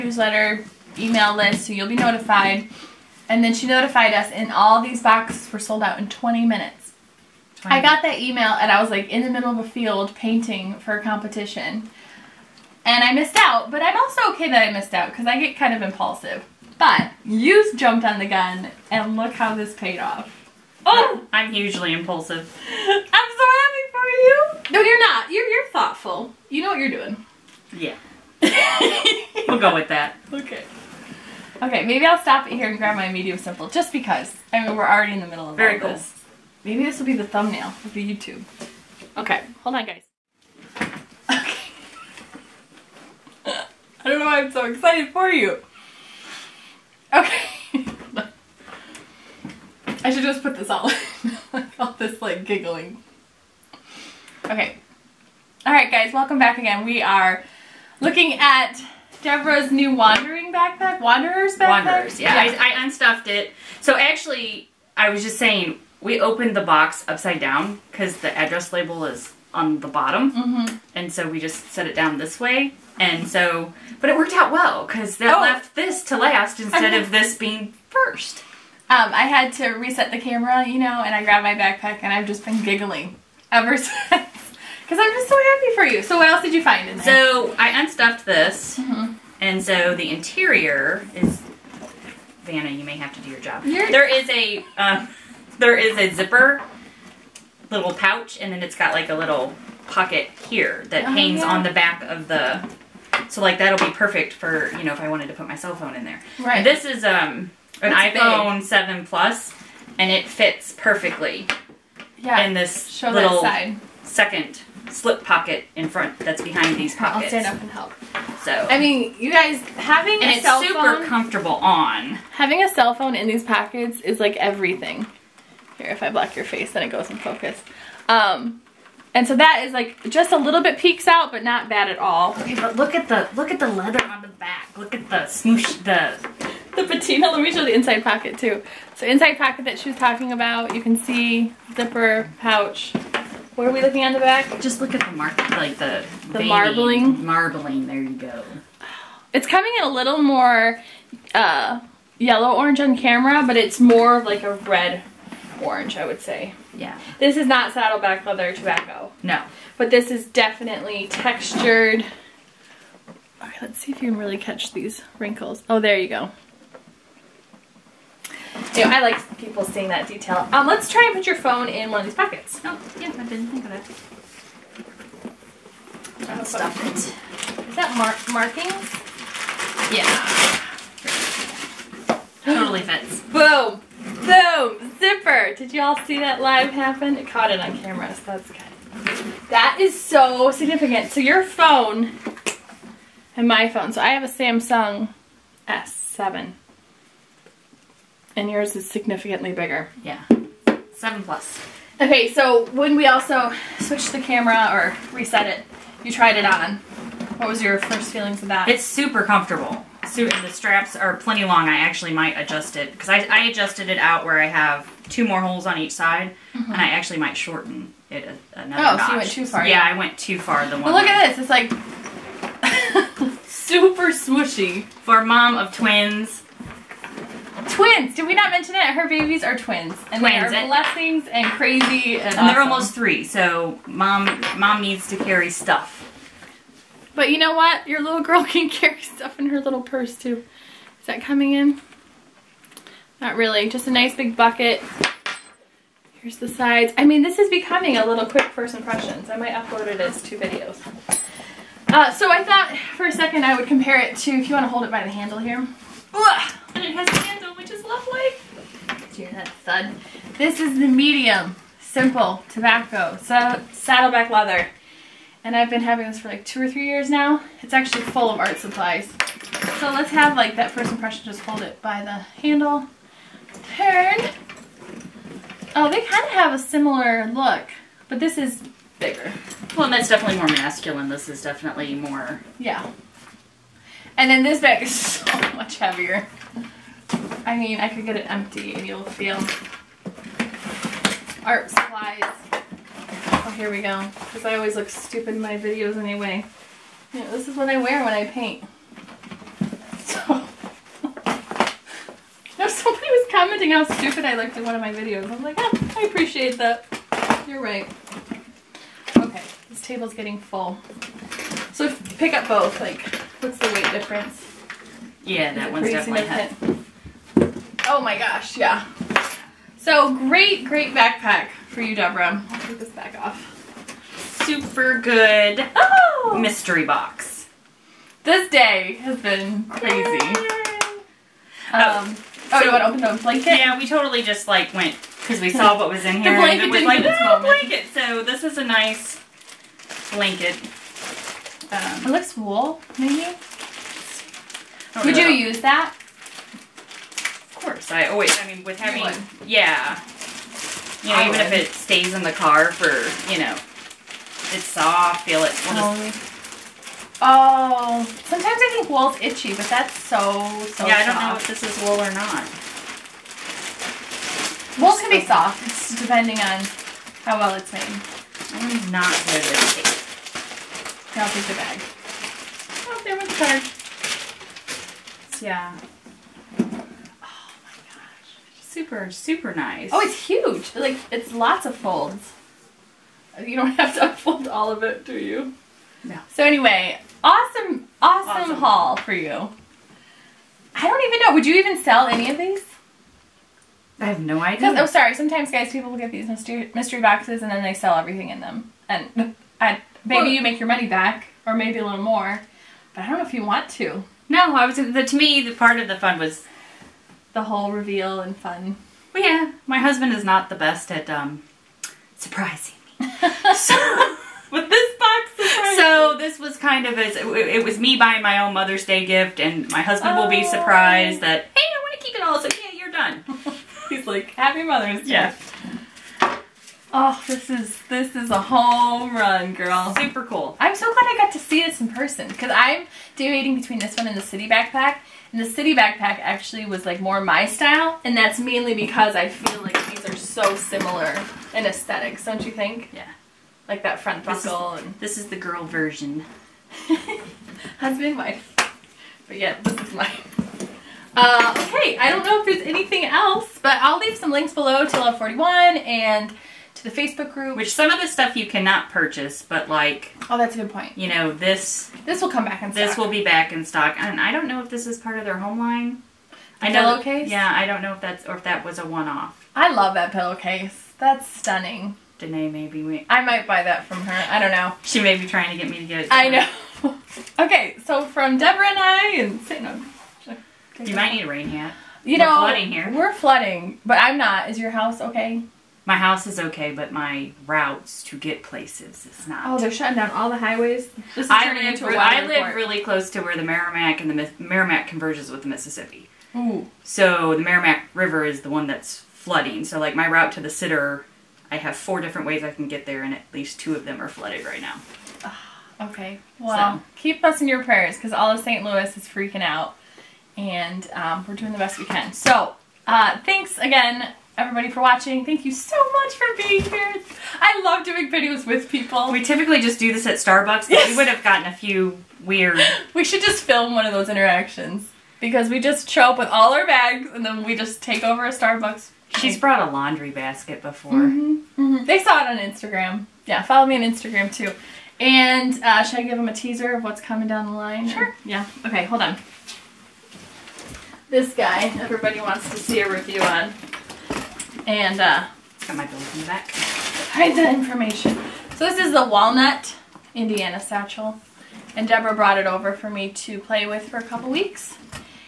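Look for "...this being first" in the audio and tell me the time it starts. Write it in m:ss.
1:17.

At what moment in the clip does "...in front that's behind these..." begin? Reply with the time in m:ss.
1:55.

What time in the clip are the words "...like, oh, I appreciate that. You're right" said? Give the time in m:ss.
5:05.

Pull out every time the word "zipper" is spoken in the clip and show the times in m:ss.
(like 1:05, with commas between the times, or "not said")
1:36, 2:21, 3:04.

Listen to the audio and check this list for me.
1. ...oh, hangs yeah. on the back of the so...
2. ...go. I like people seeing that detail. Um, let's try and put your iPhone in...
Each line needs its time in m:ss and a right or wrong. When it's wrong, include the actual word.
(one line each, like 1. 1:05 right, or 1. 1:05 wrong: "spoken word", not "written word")
1. 1:41 right
2. 2:46 wrong: "phone", not "iPhone".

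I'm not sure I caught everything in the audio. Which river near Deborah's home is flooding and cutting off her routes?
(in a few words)
Meramec River.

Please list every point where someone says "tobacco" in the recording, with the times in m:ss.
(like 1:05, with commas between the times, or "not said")
2:38, 4:22.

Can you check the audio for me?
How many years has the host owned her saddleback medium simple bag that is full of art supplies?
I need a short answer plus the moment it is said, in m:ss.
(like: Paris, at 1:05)
2 or 3 years, at 4:26.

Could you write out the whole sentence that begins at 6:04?
Wool can be soft, it's depending on how well it's made.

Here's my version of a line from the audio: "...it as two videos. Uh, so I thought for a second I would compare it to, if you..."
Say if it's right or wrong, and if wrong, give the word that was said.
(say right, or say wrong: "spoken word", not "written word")
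right.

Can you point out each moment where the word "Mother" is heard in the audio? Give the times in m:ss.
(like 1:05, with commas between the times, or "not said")
6:58, 7:04.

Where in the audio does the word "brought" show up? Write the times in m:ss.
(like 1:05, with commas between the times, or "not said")
8:49, 9:12.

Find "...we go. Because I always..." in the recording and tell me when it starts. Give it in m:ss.
4:53.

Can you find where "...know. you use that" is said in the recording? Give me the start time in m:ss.
5:45.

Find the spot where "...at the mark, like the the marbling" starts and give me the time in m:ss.
2:24.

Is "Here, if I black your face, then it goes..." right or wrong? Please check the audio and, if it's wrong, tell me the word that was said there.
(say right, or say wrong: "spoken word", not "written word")
right.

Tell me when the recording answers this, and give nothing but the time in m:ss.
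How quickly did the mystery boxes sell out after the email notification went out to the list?
0:06.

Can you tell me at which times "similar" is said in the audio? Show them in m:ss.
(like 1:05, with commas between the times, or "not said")
4:36, 7:20.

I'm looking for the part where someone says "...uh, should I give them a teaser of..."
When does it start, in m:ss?
8:55.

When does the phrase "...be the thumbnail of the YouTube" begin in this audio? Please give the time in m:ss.
0:37.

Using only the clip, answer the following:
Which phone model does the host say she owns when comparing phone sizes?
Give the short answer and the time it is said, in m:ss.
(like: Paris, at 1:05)
Samsung S7, at 3:14.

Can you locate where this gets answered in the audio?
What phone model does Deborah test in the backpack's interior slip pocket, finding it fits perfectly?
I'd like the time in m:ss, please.
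1:47.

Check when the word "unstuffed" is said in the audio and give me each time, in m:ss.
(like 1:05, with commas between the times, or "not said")
1:02, 1:27.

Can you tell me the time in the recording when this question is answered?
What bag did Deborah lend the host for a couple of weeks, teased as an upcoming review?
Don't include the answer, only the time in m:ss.
9:09.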